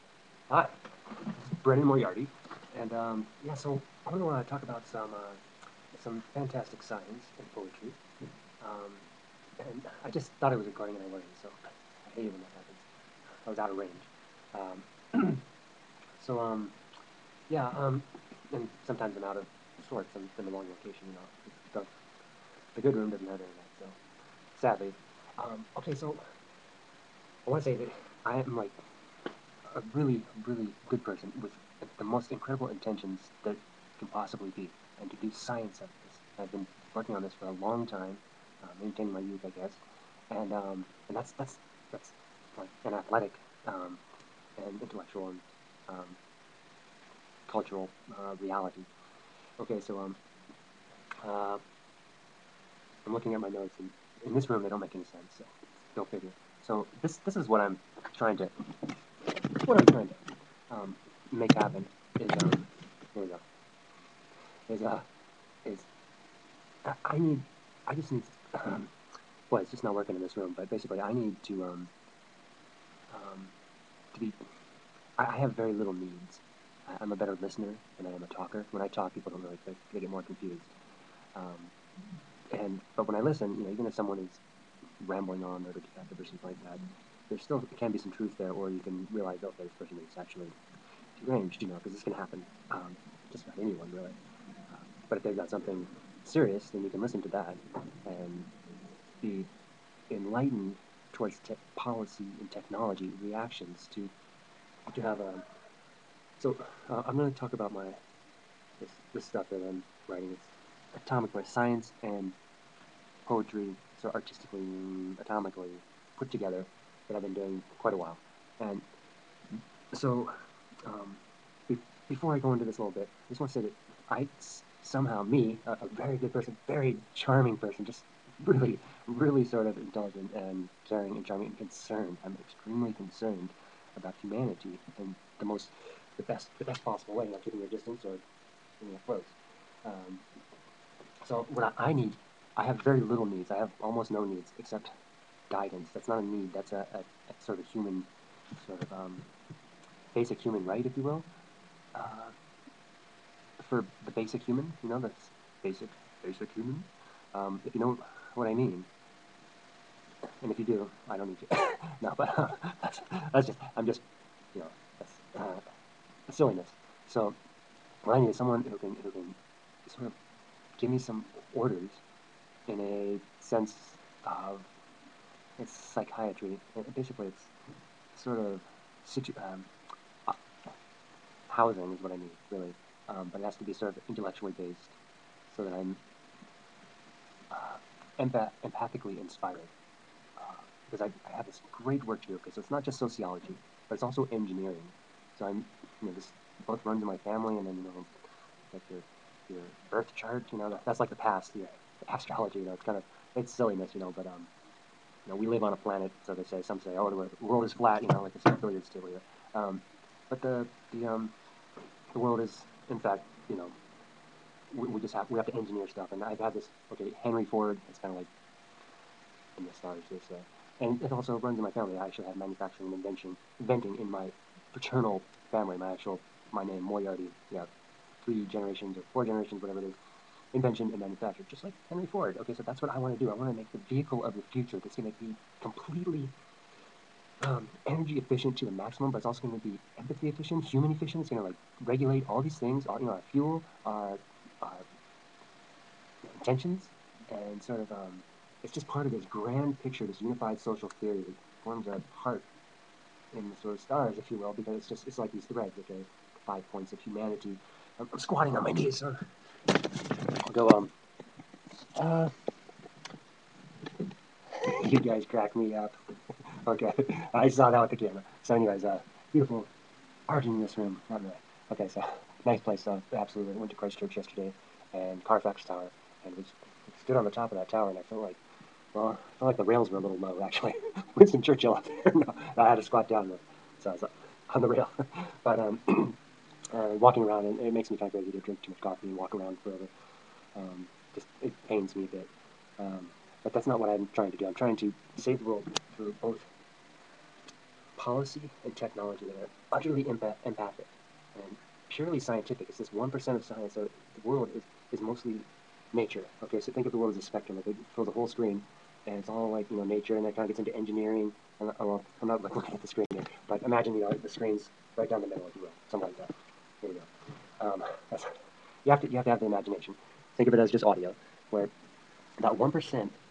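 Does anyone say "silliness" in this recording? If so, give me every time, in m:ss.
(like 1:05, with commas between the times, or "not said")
2:46, 3:23.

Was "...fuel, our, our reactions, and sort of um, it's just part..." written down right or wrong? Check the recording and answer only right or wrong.
wrong.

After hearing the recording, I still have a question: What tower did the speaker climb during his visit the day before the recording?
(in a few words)
Carfax Tower.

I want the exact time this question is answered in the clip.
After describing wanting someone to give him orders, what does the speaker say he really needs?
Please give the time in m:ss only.
3:01.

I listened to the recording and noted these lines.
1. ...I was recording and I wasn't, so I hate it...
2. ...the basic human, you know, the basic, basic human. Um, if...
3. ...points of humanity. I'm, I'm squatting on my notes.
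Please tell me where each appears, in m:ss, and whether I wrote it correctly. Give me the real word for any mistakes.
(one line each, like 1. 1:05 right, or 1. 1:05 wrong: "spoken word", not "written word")
1. 0:10 right
2. 2:34 right
3. 4:16 wrong: "knees", not "notes".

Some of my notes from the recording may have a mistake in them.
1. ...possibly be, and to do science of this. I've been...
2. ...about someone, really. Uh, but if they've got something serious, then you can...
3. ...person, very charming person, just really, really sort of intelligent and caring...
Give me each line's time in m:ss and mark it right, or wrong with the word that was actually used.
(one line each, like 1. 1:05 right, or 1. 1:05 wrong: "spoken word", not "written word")
1. 0:34 right
2. 1:33 wrong: "anyone", not "someone"
3. 2:06 right.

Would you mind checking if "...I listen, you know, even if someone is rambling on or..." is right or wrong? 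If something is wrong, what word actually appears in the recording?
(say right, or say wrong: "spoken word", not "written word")
right.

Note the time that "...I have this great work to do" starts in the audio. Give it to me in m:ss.
3:11.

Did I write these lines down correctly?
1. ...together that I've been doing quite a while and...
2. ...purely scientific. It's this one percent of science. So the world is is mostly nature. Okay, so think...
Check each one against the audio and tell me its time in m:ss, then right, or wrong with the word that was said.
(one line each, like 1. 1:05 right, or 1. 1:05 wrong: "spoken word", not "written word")
1. 1:56 right
2. 5:01 right.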